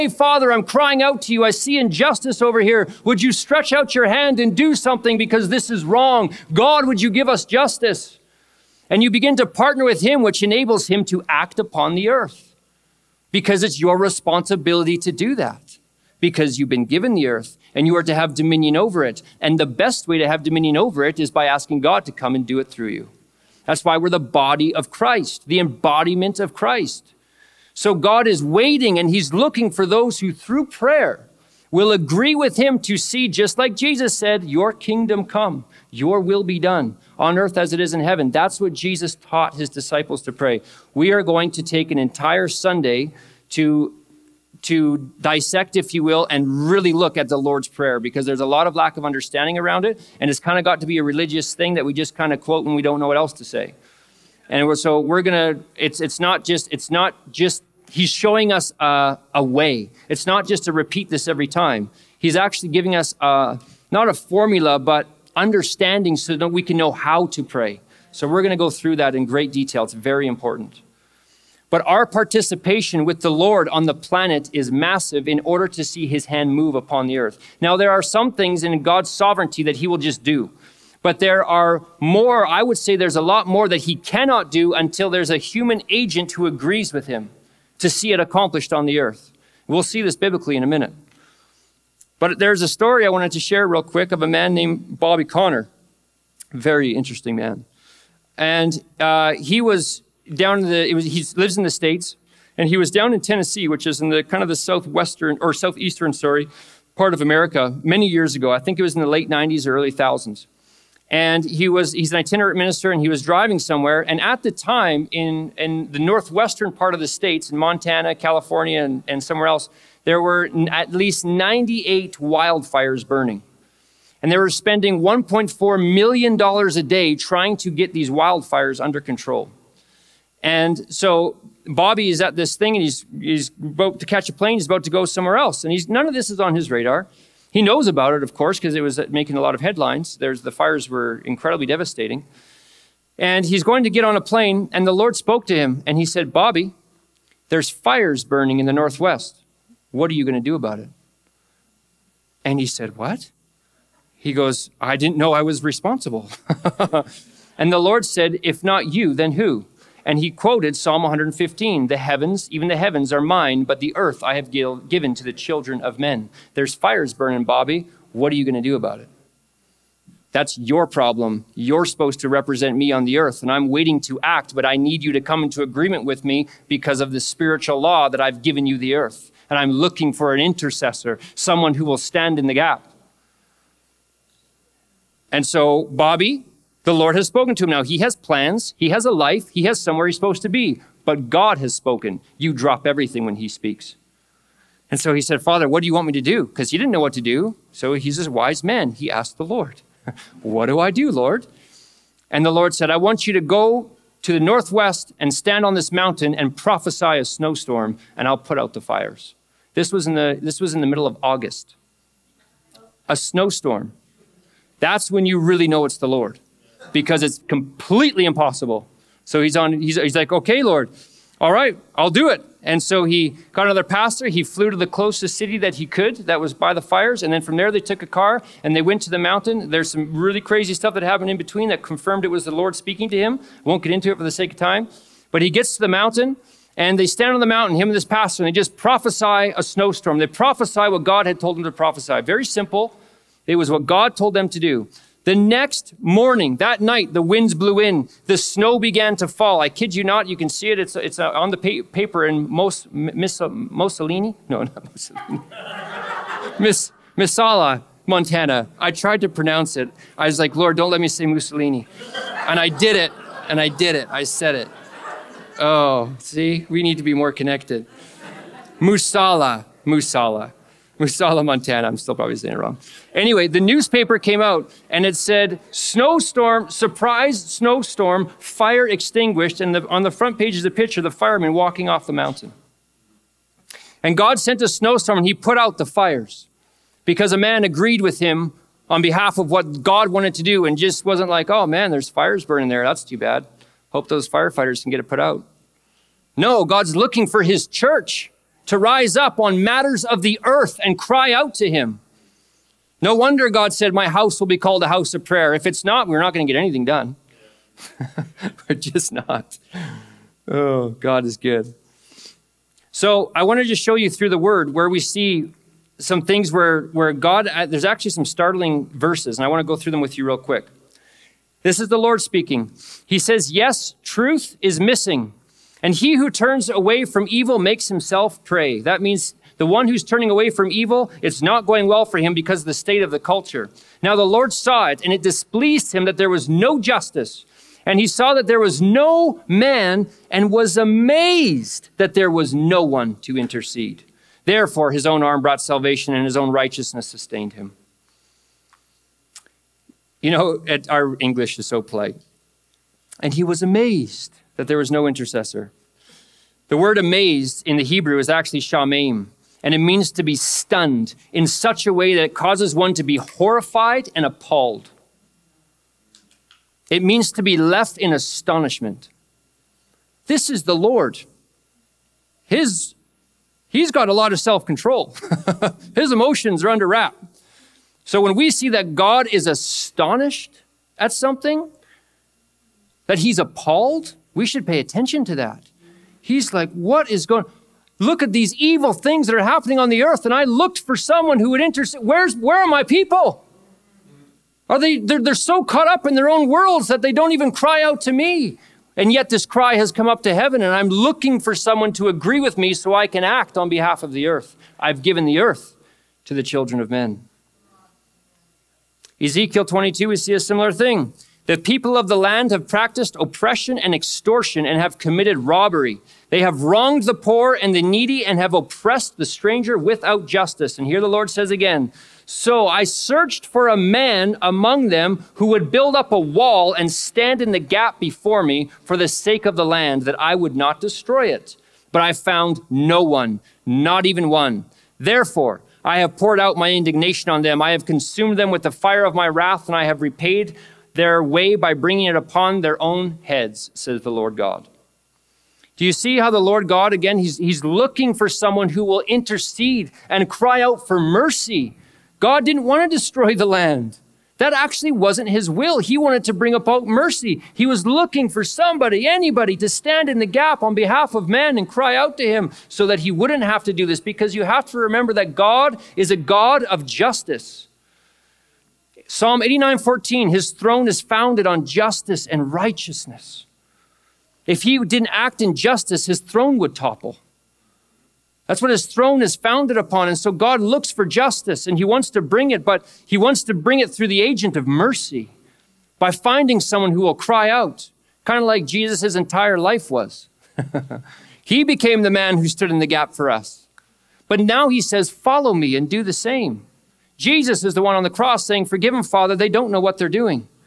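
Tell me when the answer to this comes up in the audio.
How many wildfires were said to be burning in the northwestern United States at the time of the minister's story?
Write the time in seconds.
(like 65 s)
121 s.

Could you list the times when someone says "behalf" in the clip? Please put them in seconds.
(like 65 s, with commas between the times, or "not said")
289 s, 403 s, 460 s.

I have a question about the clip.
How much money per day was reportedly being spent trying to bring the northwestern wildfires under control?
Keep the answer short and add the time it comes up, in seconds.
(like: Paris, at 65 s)
$1.4 million, at 124 s.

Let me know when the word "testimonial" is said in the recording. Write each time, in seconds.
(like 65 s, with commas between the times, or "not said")
not said.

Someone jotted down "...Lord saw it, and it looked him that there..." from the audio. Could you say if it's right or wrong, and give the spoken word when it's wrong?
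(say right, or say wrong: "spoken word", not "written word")
wrong: "displeased", not "looked".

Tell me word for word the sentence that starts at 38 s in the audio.
That's what Jesus taught his disciples to pray.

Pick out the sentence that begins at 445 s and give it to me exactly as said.
Do you see how the Lord God, again, he's, he's looking for someone who will intercede and cry out for mercy?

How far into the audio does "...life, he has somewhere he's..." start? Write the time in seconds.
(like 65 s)
189 s.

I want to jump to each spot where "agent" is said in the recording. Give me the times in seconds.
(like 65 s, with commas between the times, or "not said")
85 s, 484 s.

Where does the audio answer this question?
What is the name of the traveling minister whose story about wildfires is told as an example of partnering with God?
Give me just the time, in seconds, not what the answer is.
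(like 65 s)
94 s.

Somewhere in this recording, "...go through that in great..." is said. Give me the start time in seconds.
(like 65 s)
68 s.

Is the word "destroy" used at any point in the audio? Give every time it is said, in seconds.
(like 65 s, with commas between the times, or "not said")
430 s, 452 s.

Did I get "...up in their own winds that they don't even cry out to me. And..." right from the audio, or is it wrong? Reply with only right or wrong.
wrong.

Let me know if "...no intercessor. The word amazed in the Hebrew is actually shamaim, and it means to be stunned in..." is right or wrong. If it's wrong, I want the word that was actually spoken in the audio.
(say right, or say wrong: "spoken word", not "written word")
right.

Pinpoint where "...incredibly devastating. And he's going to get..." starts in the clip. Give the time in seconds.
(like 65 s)
141 s.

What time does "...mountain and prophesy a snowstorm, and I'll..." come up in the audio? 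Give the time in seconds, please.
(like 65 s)
205 s.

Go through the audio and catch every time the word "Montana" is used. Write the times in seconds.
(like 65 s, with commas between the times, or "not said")
117 s, 258 s, 271 s.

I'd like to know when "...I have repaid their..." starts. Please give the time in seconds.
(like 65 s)
439 s.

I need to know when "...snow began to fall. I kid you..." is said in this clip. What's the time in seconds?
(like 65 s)
248 s.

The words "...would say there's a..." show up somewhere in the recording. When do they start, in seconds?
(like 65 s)
82 s.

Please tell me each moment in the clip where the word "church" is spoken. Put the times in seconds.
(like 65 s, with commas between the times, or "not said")
297 s.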